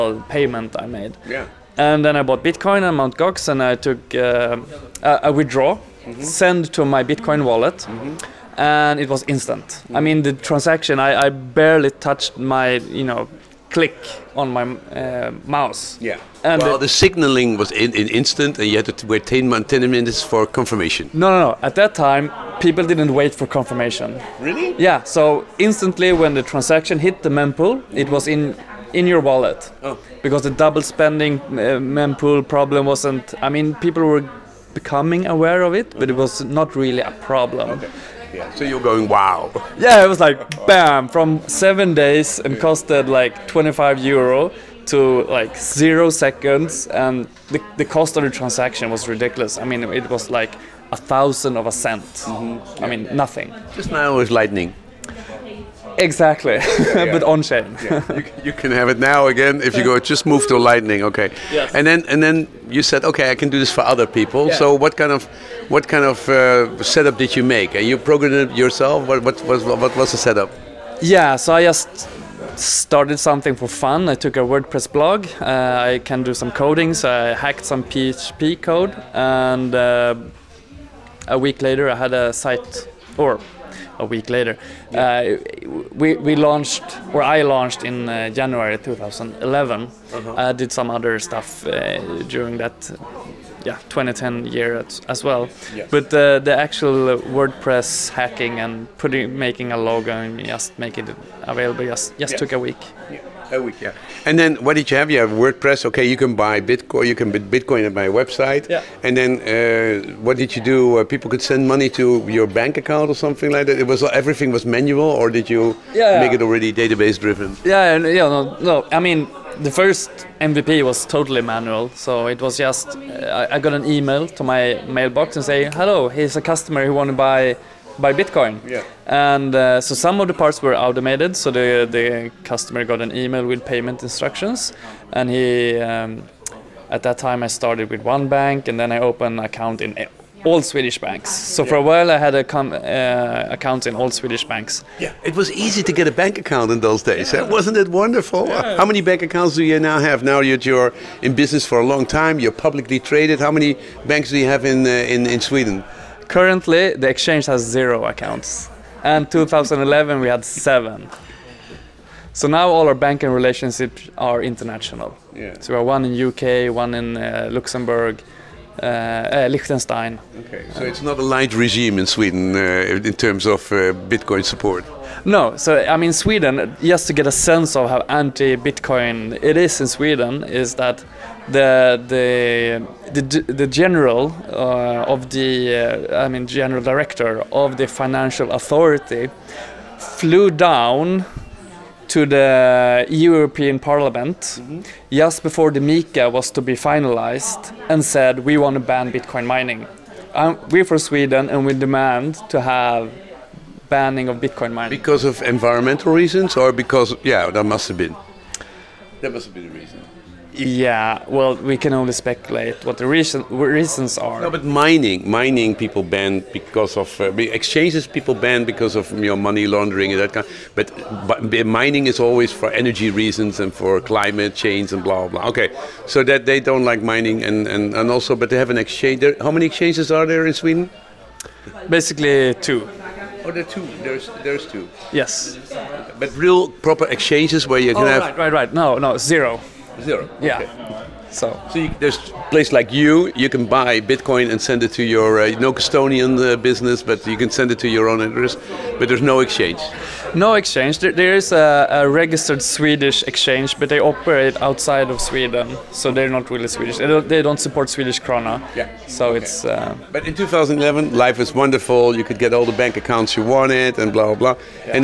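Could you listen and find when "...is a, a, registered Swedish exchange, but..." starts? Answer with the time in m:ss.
4:11.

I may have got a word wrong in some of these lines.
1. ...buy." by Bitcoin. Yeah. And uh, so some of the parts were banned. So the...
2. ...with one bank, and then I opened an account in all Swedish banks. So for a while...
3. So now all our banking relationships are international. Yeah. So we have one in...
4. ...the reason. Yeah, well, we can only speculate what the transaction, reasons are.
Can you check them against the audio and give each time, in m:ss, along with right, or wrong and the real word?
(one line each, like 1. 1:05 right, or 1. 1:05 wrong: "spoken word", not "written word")
1. 2:07 wrong: "automated", not "banned"
2. 2:17 right
3. 2:42 right
4. 3:29 wrong: "reason", not "transaction".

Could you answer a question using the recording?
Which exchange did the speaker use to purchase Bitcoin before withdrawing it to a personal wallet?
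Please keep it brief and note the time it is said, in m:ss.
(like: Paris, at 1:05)
Mt. Gox, at 0:02.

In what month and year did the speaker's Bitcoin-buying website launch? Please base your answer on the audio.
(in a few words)
January 2011.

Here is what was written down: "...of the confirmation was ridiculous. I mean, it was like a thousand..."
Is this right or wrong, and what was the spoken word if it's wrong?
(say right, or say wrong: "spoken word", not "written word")
wrong: "transaction", not "confirmation".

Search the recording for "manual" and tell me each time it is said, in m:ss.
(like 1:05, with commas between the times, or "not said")
1:54, 2:01.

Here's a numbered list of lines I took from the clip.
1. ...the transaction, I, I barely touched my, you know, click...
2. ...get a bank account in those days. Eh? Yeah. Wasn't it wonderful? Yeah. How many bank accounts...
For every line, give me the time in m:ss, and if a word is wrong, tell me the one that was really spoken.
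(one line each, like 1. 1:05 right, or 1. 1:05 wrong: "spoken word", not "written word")
1. 0:10 right
2. 2:25 right.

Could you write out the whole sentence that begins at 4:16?
They don't, they don't support Swedish krona.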